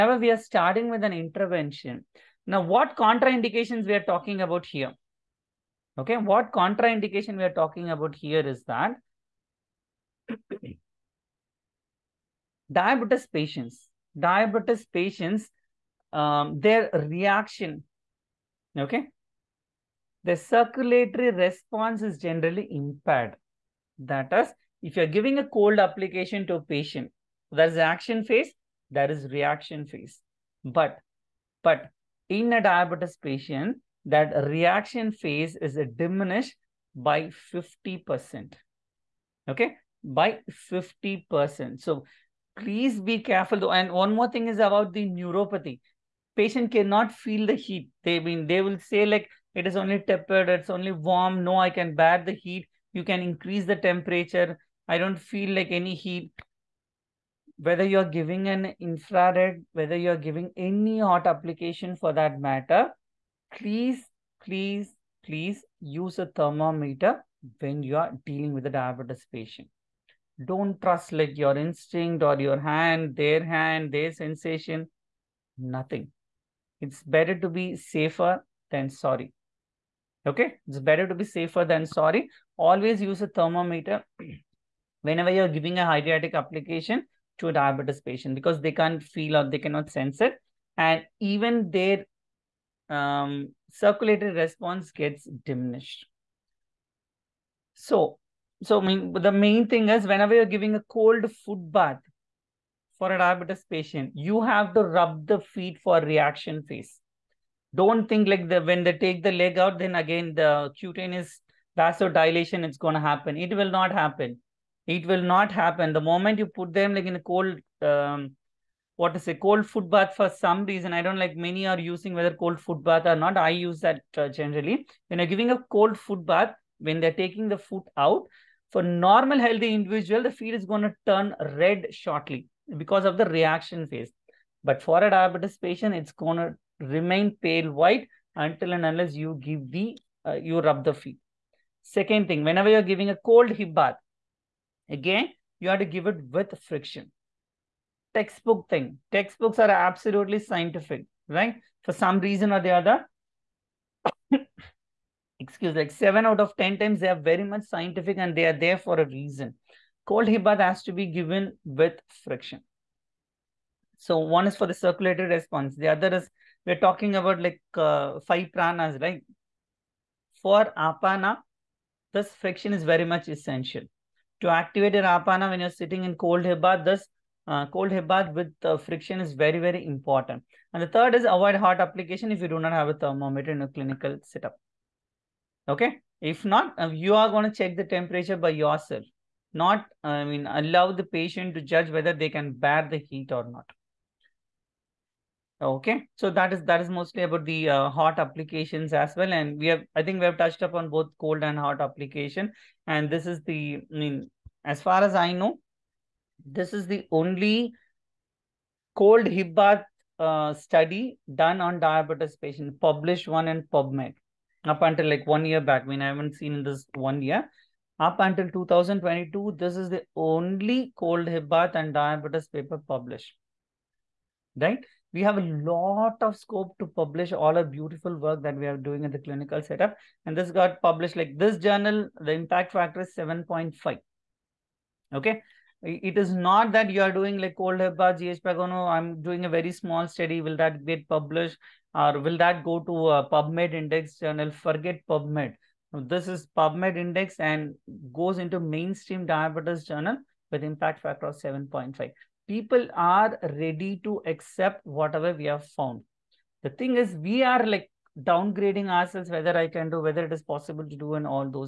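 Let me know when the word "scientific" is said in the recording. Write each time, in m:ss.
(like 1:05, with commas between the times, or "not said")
2:30, 2:37.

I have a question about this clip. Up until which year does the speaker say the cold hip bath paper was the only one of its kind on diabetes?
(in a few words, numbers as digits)
2022.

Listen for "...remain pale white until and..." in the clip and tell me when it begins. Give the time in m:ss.
2:16.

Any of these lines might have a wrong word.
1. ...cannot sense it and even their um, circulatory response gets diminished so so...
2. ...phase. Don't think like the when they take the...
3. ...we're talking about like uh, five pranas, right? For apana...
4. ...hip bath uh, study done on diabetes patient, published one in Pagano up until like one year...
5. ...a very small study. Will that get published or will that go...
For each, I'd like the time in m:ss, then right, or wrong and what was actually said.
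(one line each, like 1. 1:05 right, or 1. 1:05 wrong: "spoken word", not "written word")
1. 1:29 right
2. 1:46 right
3. 2:46 right
4. 3:29 wrong: "PubMed", not "Pagano"
5. 3:59 right.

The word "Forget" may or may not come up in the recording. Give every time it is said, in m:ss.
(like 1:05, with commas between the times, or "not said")
4:04.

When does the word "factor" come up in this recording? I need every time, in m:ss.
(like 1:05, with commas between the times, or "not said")
3:52, 4:11.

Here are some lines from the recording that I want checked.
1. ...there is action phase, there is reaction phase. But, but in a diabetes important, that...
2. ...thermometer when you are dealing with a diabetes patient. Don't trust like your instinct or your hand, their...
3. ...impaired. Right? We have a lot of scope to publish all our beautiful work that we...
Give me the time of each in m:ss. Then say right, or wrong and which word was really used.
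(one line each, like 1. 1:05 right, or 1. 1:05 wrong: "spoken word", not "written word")
1. 0:27 wrong: "patient", not "important"
2. 1:06 right
3. 3:42 wrong: "published", not "impaired".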